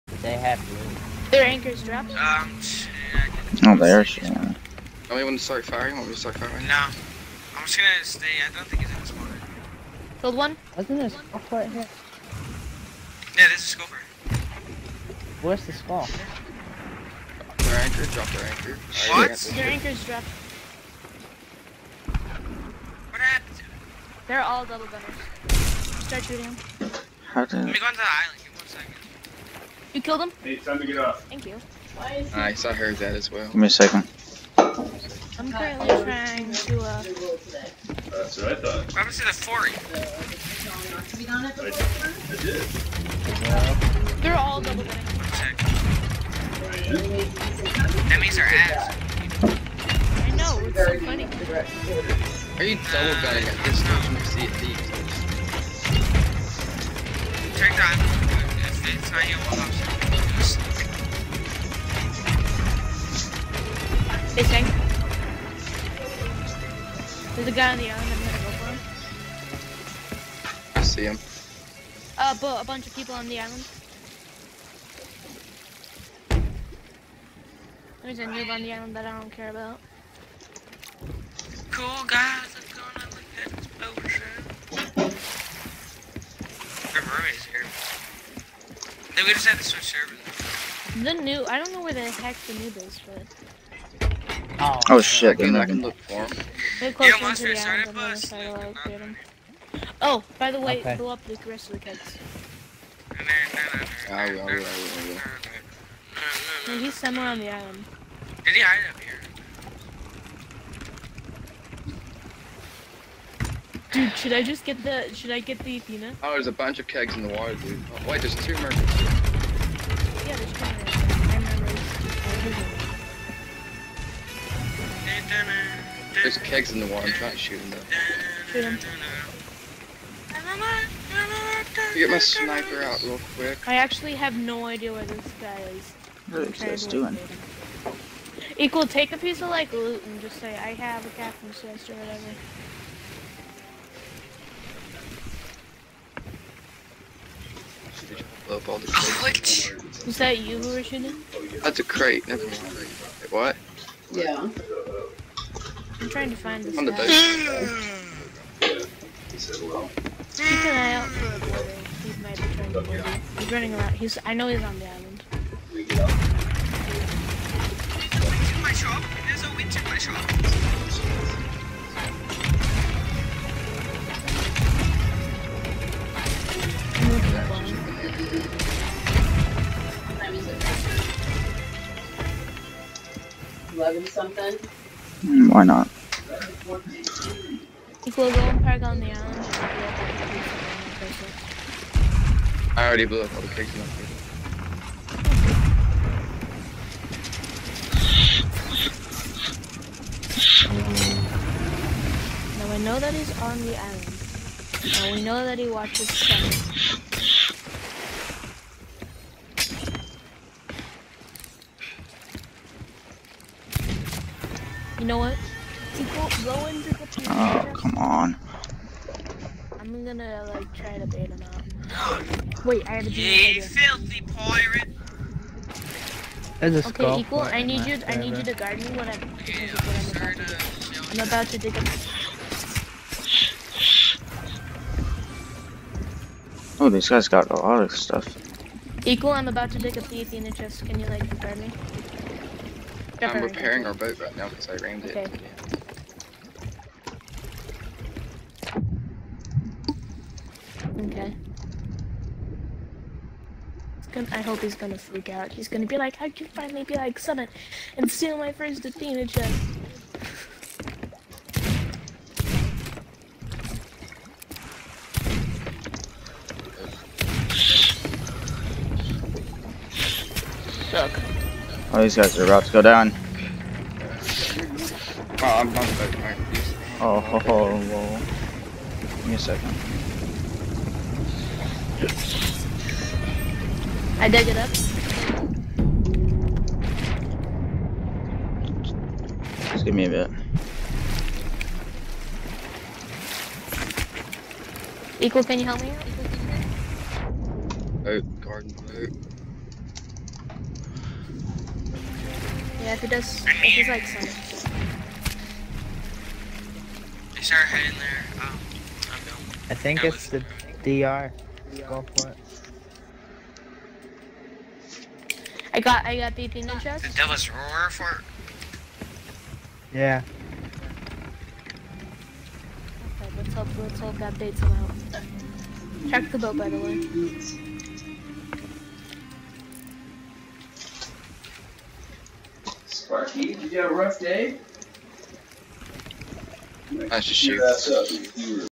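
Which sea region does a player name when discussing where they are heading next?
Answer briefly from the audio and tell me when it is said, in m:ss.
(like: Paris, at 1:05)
Devil's Roar, at 5:17.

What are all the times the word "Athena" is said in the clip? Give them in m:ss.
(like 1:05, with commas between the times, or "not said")
1:55, 4:00, 4:18.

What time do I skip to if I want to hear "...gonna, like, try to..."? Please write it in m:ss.
3:40.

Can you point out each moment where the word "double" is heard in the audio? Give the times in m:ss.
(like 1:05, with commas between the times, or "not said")
0:24, 0:44, 0:52.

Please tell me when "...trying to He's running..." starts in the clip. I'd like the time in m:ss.
2:42.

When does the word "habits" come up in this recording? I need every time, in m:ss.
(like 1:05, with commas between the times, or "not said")
not said.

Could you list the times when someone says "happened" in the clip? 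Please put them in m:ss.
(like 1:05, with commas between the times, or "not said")
0:23.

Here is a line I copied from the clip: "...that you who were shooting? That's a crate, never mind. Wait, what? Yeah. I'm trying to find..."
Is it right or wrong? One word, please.
right.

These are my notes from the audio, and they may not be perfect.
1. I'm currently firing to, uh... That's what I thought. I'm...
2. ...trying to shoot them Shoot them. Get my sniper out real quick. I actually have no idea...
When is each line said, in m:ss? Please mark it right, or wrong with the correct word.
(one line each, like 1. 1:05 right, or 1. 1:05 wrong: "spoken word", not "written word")
1. 0:34 wrong: "trying", not "firing"
2. 2:07 right.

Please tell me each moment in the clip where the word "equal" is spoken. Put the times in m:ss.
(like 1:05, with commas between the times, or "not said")
2:18, 3:47, 3:59, 4:55.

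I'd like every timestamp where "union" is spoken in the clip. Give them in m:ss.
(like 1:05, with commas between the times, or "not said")
not said.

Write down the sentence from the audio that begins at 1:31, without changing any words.
The new, I don't know where the heck the new is, but.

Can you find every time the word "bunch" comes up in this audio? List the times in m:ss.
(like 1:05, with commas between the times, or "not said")
1:12, 1:56.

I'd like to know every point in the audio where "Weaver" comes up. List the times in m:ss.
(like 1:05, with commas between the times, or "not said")
not said.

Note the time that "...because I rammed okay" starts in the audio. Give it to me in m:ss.
4:04.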